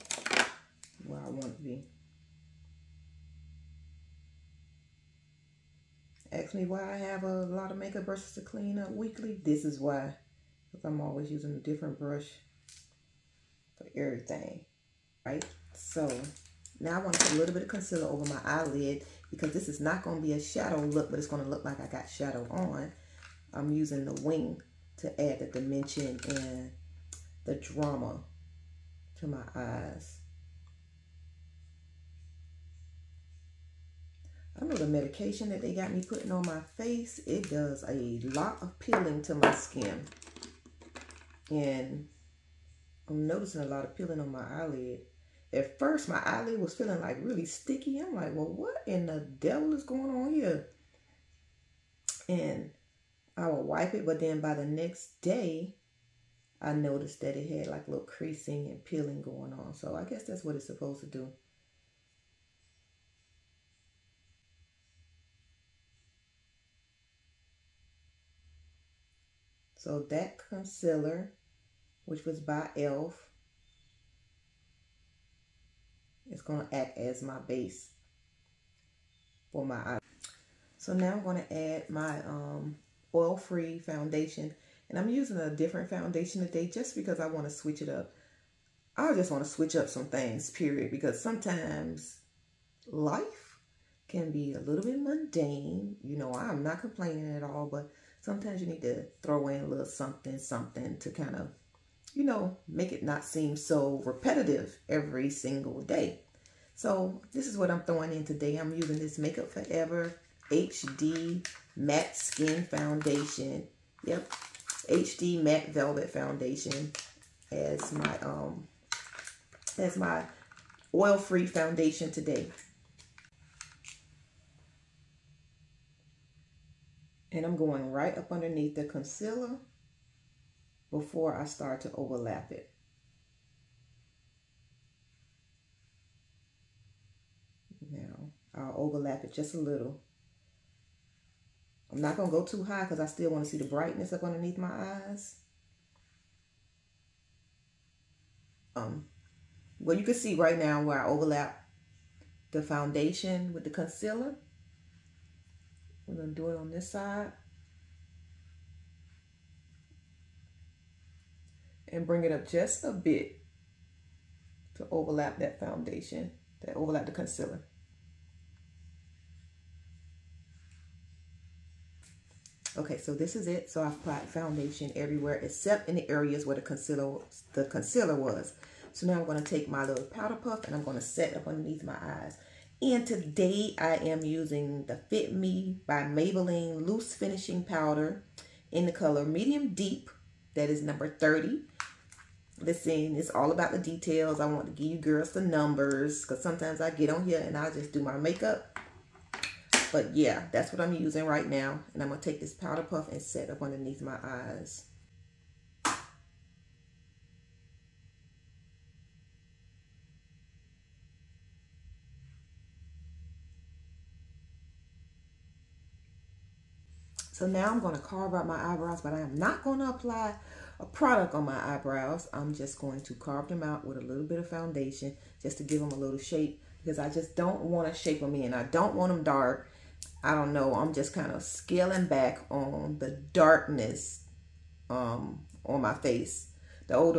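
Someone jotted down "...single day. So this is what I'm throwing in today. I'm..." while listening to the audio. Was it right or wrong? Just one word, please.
right.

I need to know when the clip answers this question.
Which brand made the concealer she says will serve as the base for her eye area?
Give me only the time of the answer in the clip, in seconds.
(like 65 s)
72 s.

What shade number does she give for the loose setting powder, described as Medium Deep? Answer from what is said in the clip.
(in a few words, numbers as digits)
30.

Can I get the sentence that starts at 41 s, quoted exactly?
And I'm noticing a lot of peeling on my eyelid.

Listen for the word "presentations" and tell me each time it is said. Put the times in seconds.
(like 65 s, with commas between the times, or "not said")
not said.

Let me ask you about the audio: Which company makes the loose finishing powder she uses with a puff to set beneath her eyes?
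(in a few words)
Maybelline.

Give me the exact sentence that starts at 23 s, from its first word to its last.
I'm using the wing to add the dimension and the drama to my eyes.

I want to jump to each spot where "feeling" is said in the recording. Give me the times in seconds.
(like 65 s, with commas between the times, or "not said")
46 s.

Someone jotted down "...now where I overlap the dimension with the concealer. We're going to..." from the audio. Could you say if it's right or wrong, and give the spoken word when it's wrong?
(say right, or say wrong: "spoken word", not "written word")
wrong: "foundation", not "dimension".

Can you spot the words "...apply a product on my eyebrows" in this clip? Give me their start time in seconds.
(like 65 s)
219 s.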